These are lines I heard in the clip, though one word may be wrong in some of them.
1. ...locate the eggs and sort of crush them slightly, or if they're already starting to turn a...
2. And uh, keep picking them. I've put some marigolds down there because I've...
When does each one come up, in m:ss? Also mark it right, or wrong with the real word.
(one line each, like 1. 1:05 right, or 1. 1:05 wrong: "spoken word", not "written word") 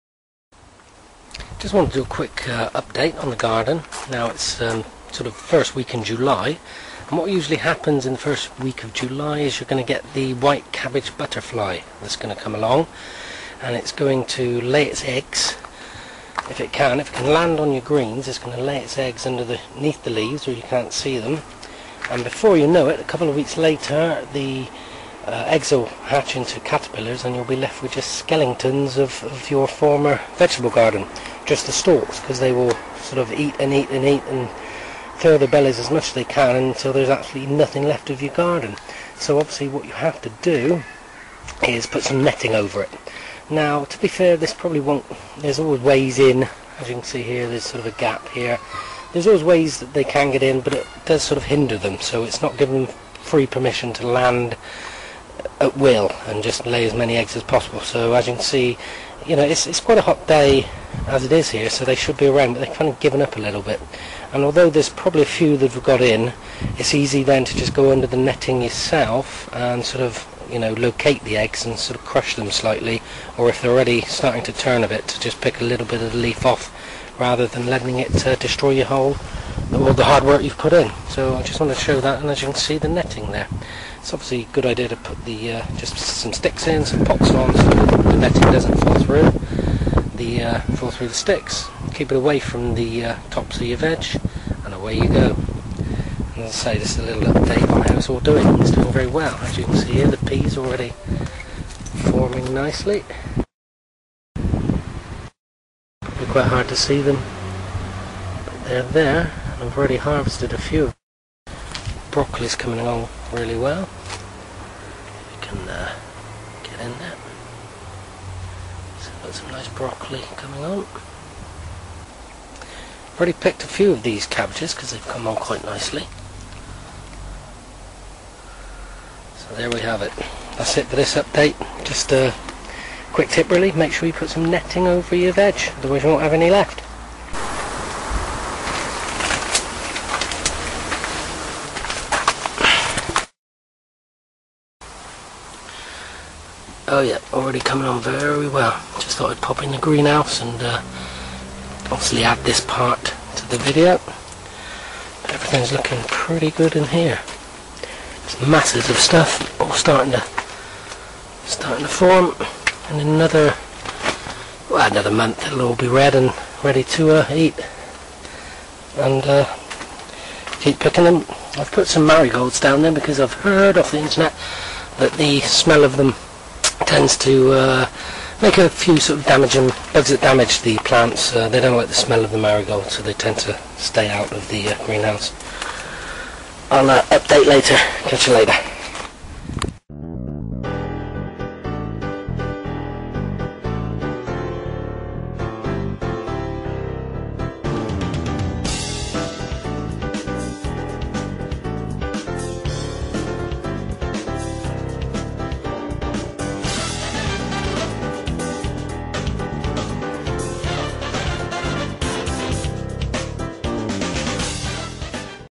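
1. 1:10 right
2. 2:48 right.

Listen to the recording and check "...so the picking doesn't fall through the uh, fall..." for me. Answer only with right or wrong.
wrong.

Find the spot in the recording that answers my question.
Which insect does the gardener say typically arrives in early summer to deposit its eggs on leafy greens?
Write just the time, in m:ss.
0:10.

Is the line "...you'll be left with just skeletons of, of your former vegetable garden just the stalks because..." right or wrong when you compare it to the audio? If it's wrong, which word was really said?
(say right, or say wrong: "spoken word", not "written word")
right.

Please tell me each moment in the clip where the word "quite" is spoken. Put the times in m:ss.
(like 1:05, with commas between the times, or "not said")
0:59, 1:46, 2:05.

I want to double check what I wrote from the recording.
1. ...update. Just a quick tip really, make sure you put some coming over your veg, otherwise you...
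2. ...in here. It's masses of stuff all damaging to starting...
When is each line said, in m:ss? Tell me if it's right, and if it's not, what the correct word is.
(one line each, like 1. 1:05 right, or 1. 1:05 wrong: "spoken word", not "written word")
1. 2:11 wrong: "netting", not "coming"
2. 2:36 wrong: "starting", not "damaging".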